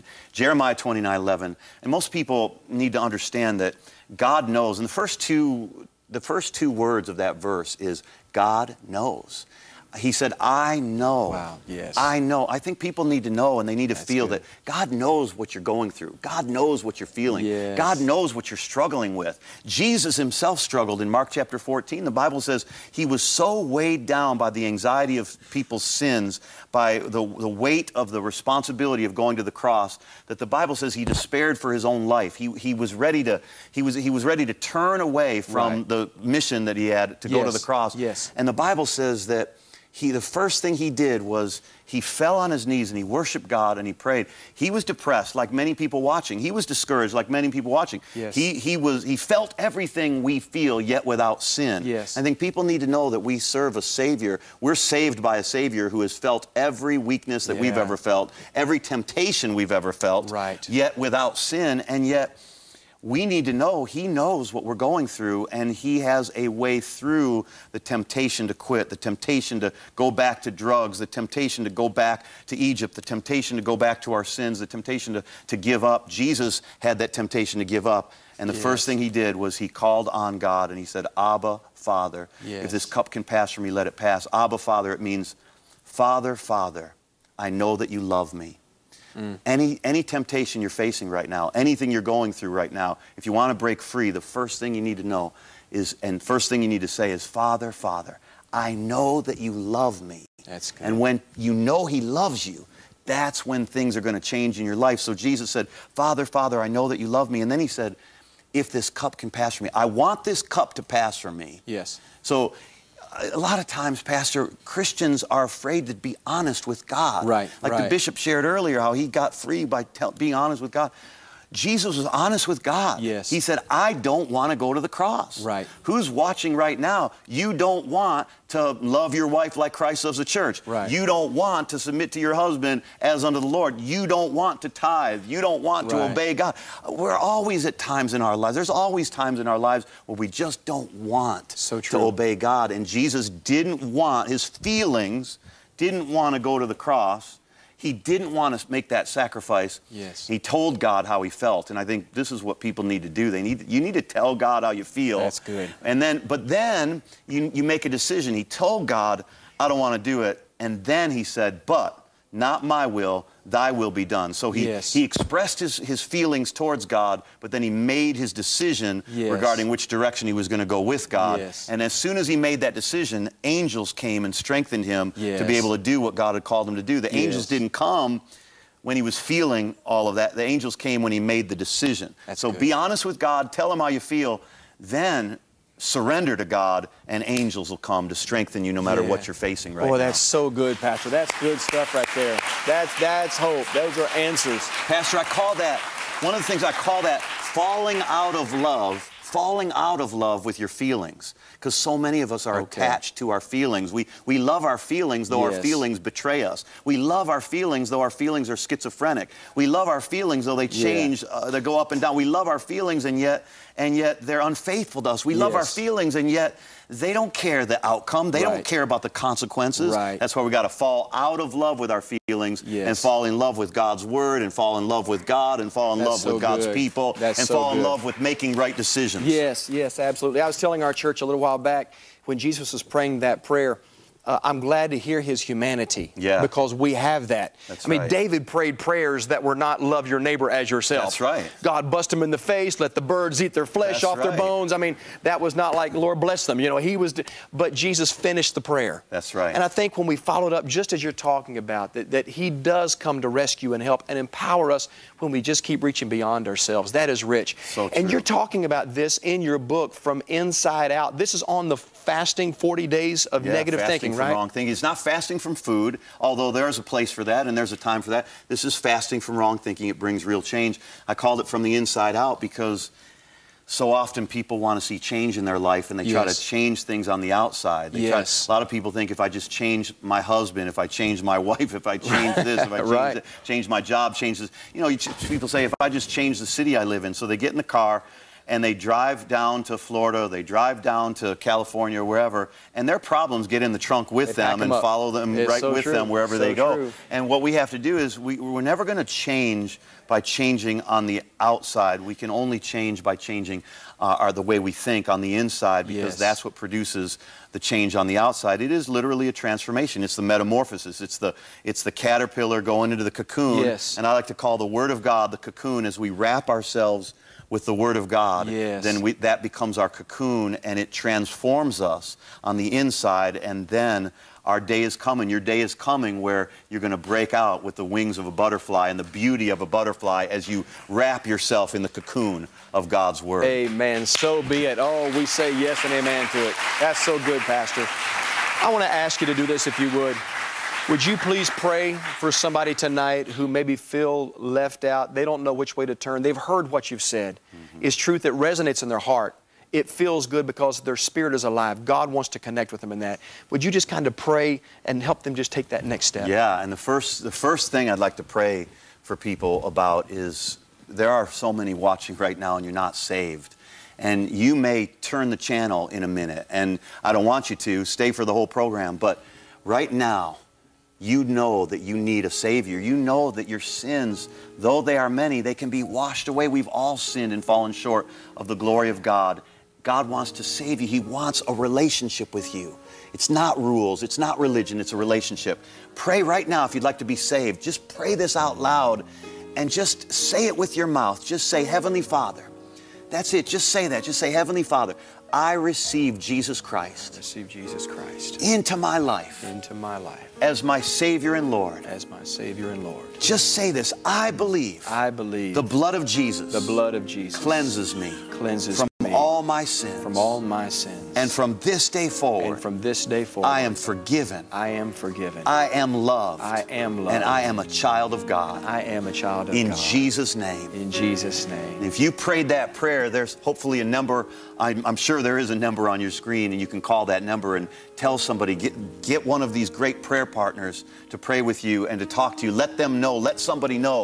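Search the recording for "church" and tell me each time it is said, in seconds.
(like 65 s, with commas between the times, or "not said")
130 s, 230 s.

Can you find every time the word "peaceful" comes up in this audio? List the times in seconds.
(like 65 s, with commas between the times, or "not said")
not said.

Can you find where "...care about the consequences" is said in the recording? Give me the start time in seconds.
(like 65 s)
218 s.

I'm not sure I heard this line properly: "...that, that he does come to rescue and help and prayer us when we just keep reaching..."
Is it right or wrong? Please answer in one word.
wrong.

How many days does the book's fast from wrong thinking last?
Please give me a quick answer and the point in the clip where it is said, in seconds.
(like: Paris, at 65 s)
40, at 262 s.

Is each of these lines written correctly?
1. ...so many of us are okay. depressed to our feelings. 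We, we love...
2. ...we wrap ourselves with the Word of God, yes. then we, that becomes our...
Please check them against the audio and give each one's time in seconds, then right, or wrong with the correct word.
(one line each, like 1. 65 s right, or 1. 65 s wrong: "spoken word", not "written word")
1. 201 s wrong: "attached", not "depressed"
2. 315 s right.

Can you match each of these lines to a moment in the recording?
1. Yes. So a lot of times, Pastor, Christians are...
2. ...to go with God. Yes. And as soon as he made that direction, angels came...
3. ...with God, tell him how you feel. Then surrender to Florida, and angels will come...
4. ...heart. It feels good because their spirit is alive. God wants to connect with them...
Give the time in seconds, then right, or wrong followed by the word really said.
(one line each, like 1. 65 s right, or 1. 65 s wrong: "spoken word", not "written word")
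1. 111 s right
2. 170 s wrong: "decision", not "direction"
3. 183 s wrong: "God", not "Florida"
4. 348 s right.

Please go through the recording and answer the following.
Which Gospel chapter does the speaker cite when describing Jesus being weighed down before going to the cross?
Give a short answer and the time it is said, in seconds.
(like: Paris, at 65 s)
Mark 14, at 21 s.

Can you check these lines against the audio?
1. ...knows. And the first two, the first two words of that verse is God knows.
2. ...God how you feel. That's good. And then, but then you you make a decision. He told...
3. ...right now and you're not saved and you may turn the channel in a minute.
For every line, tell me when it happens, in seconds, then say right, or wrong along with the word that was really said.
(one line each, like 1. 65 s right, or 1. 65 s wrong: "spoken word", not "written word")
1. 4 s right
2. 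154 s right
3. 362 s right.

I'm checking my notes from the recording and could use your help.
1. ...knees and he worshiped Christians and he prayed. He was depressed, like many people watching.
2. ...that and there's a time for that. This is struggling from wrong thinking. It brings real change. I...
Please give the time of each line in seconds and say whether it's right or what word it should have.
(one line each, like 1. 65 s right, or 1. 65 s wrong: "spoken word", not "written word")
1. 42 s wrong: "God", not "Christians"
2. 267 s wrong: "fasting", not "struggling".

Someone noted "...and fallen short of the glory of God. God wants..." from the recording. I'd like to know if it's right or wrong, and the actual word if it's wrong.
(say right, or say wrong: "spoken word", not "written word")
right.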